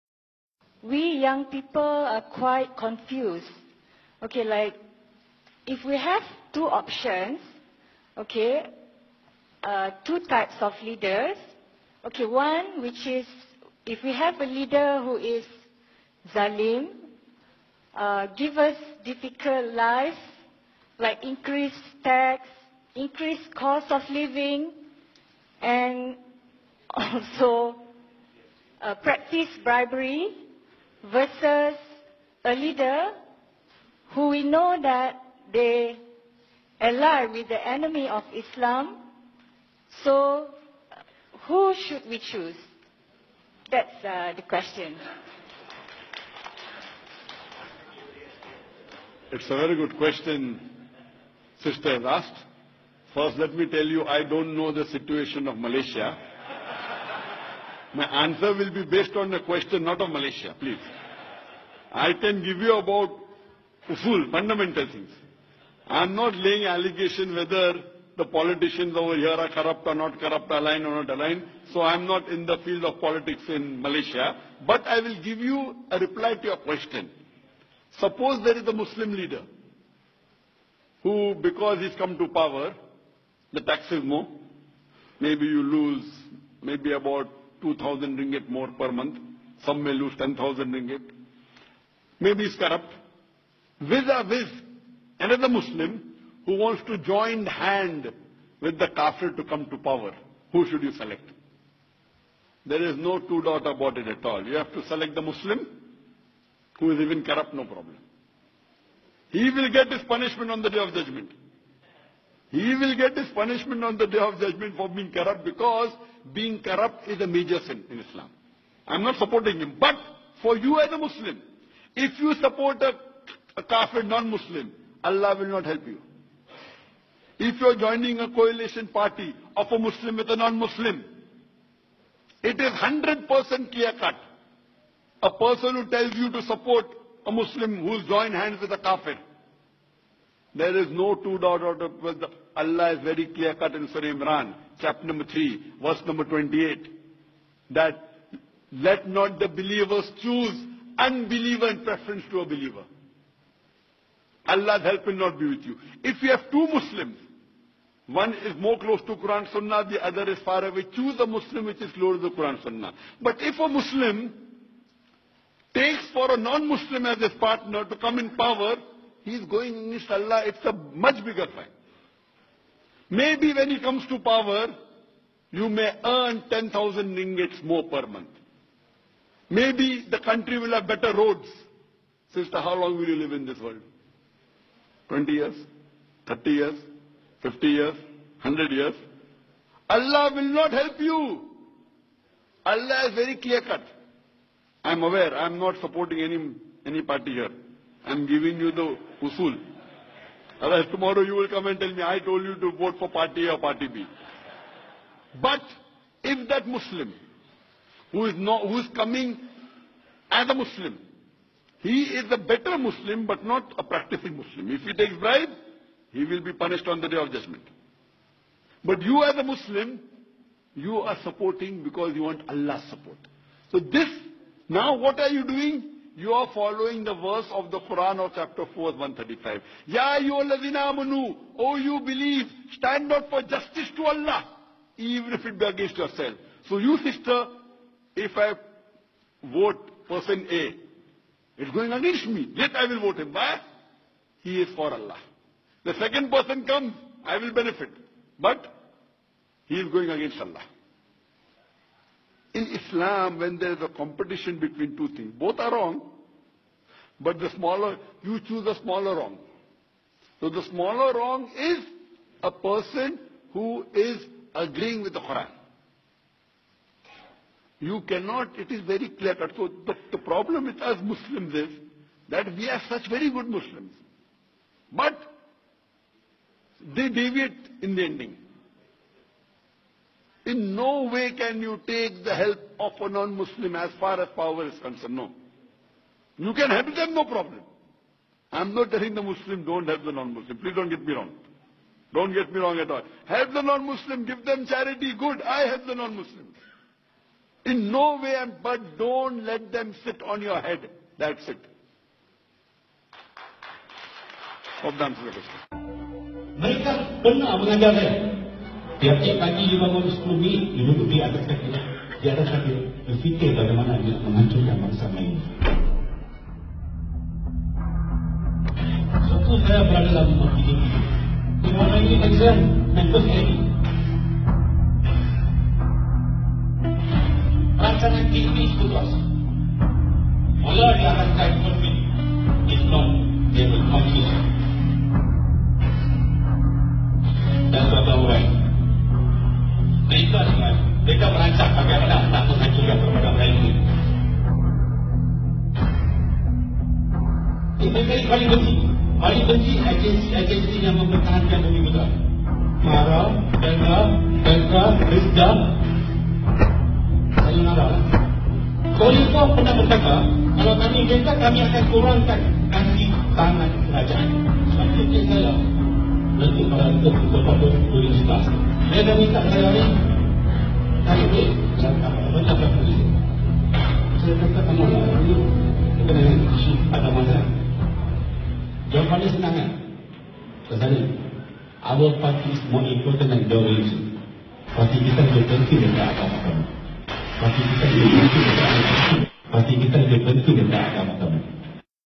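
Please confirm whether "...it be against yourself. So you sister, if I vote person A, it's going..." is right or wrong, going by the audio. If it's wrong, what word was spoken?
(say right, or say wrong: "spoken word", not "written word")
right.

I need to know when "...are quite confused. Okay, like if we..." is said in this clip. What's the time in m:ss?
0:01.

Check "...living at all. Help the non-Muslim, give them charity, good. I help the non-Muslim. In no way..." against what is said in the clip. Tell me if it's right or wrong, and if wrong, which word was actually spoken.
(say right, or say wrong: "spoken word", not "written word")
wrong: "wrong", not "living".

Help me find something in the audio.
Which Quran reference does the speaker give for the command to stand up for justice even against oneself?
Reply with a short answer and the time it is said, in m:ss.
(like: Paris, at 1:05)
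Chapter 4, 135, at 3:48.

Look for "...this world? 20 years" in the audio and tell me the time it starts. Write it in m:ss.
3:03.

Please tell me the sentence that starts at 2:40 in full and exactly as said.
Choose a Muslim which is close to Quran Sunnah.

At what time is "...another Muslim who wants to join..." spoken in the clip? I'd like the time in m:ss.
1:35.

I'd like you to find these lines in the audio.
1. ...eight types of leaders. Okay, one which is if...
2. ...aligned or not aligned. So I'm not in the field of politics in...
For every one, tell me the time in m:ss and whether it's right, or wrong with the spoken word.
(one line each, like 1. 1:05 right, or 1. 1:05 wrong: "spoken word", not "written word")
1. 0:10 wrong: "two", not "eight"
2. 1:10 right.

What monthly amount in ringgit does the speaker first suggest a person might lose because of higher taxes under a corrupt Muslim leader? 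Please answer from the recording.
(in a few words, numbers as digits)
2,000 ringgit.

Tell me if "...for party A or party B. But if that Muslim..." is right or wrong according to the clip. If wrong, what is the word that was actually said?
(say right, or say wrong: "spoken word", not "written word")
right.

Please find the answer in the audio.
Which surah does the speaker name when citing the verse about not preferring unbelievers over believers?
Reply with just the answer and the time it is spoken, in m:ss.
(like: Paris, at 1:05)
Surah Imran, at 2:23.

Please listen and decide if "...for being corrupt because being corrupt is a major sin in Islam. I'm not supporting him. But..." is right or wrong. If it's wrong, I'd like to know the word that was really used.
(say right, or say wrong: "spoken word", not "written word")
right.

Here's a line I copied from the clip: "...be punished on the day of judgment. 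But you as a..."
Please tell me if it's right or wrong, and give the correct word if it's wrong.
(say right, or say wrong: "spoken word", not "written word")
right.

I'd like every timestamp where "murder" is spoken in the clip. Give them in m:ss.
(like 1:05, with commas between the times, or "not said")
not said.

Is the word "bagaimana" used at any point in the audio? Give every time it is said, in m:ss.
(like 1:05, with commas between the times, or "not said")
5:13.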